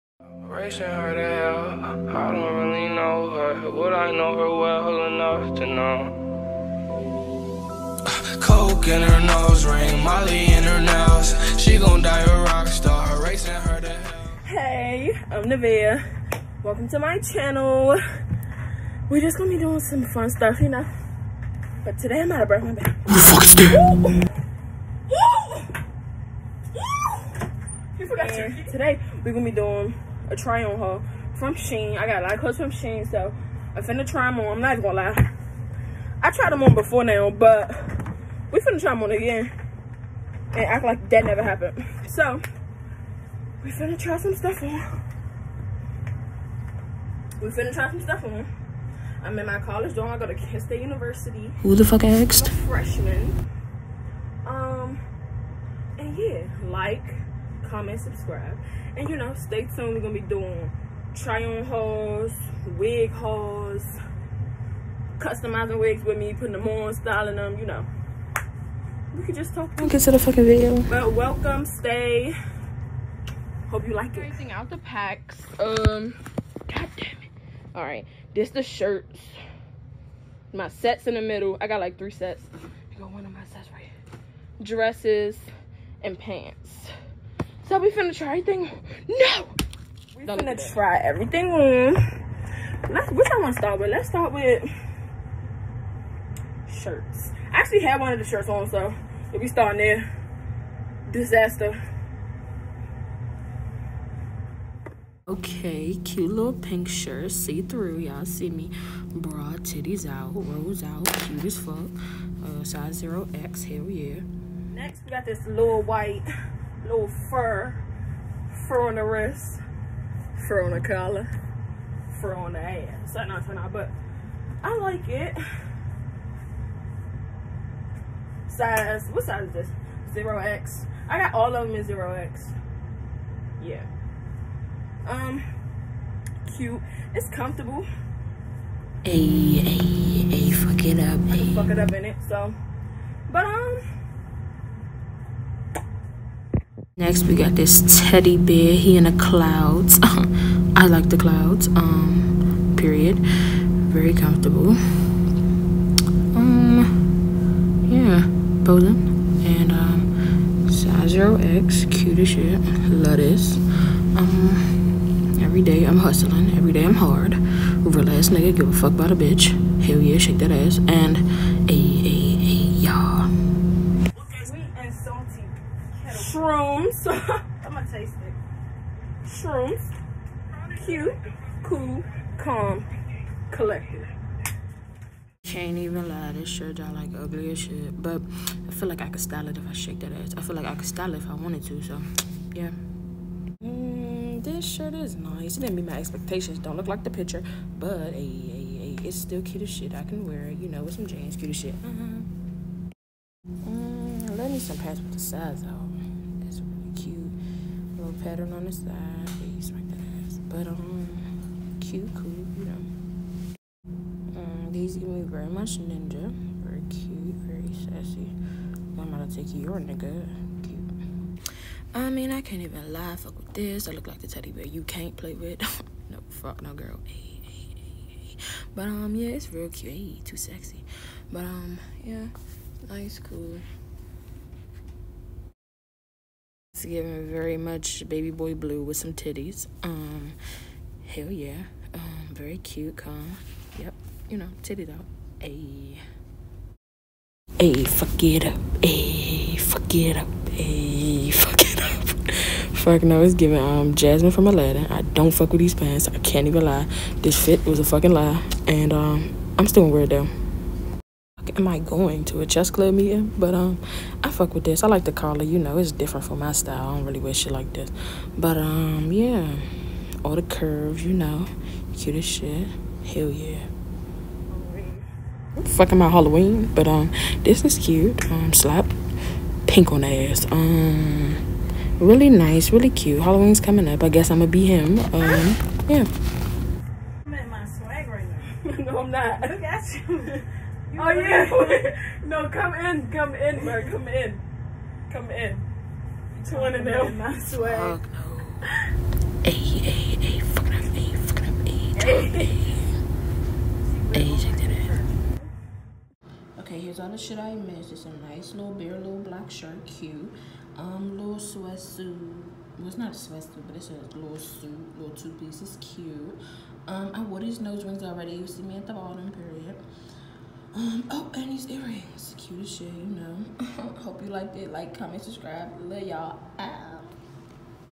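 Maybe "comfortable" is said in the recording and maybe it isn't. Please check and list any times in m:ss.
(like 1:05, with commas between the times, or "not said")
2:17, 2:34.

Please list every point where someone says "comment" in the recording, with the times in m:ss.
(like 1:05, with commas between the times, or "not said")
0:57, 5:24.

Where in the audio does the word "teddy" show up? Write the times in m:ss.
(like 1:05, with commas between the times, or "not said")
2:28, 3:44.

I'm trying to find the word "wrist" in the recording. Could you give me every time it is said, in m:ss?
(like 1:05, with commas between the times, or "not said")
1:59.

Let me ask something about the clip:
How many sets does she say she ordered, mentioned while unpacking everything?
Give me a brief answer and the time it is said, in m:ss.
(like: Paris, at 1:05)
3, at 1:21.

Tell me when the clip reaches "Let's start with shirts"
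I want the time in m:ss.
1:33.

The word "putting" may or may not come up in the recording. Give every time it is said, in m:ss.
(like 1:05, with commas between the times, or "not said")
1:06.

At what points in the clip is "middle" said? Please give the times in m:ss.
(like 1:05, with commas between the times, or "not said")
1:21.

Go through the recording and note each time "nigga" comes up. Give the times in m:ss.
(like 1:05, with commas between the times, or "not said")
2:48, 3:39.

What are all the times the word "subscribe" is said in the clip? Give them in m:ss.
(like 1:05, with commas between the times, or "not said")
0:58, 5:25.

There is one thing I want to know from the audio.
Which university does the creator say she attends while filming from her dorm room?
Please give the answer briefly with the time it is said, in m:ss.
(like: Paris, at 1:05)
Kent State University, at 0:50.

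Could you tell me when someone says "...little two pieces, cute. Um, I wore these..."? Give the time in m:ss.
5:14.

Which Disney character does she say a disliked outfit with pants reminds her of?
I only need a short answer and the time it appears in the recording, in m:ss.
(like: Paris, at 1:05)
Jasmine, at 4:13.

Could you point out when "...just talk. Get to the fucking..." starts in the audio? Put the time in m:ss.
1:09.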